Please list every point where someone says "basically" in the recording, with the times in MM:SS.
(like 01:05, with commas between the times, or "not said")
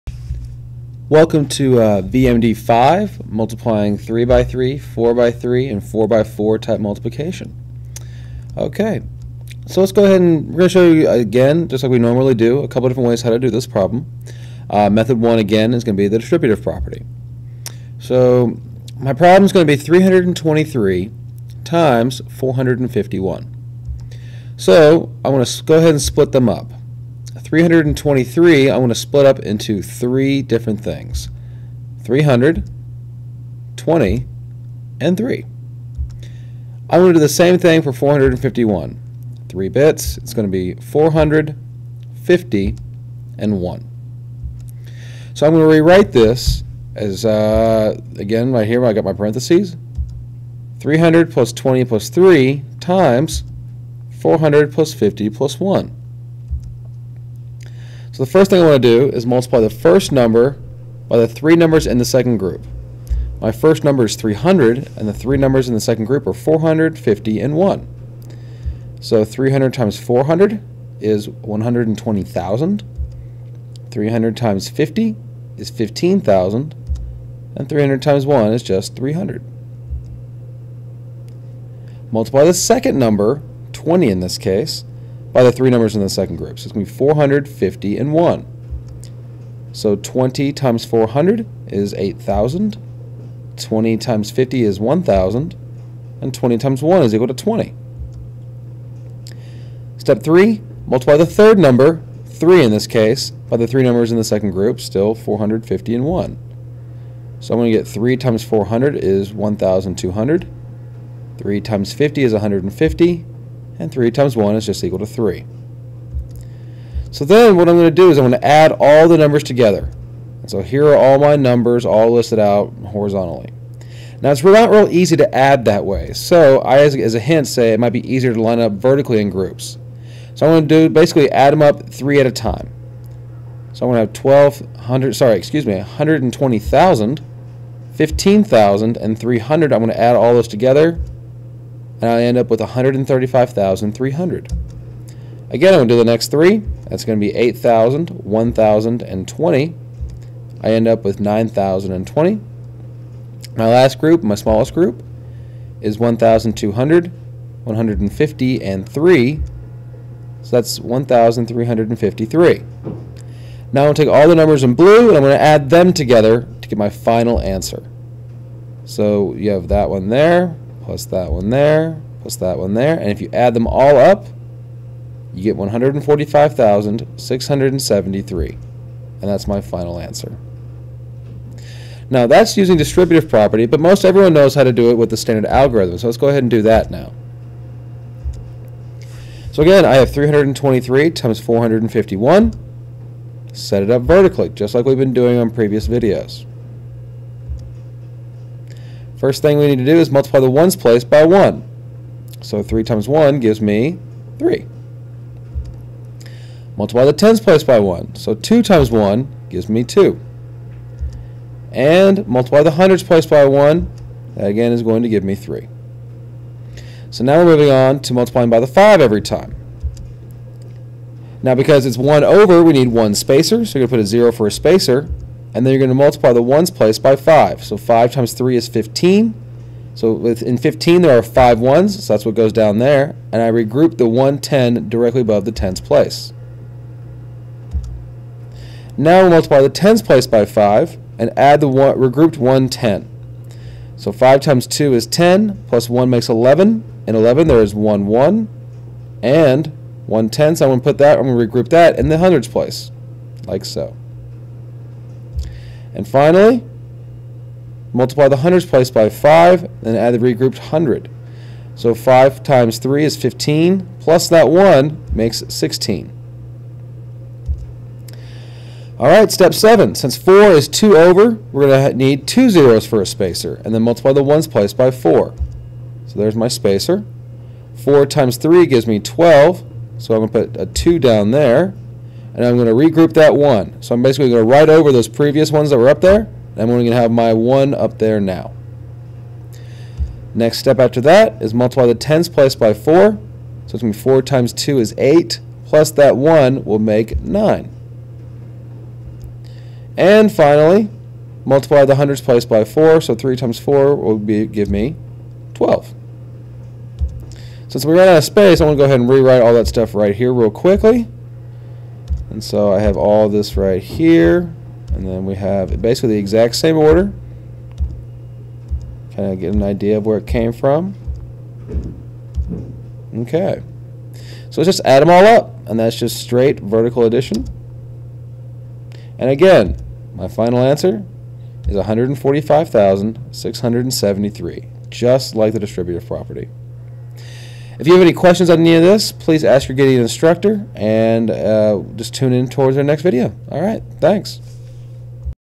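02:10, 04:44, 05:15.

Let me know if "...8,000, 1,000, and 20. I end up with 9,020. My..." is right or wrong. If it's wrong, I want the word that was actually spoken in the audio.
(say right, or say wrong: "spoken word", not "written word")
right.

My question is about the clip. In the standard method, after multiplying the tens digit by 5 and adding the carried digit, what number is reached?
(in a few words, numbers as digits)
11.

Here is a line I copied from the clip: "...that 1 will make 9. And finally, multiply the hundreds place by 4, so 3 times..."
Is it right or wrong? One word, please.
right.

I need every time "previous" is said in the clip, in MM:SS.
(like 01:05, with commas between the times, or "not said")
03:15, 04:45.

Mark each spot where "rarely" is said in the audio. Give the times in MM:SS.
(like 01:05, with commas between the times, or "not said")
not said.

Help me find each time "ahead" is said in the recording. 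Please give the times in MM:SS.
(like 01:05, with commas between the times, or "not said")
00:10, 00:25, 03:06, 05:08.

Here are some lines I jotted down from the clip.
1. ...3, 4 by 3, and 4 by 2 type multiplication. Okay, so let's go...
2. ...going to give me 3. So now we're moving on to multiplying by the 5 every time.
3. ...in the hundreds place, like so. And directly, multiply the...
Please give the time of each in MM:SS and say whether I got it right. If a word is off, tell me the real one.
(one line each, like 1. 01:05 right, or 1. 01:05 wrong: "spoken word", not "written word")
1. 00:04 wrong: "4", not "2"
2. 03:34 right
3. 04:11 wrong: "finally", not "directly".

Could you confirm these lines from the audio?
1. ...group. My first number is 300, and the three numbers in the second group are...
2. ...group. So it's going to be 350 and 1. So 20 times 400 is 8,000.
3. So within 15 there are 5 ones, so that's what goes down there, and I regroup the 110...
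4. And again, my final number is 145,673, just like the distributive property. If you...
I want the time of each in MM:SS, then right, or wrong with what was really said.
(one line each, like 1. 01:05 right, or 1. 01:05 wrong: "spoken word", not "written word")
1. 01:02 right
2. 01:26 wrong: "450", not "350"
3. 03:49 right
4. 05:29 wrong: "answer", not "number".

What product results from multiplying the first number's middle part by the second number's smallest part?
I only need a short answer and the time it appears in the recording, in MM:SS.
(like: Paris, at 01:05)
20, at 01:36.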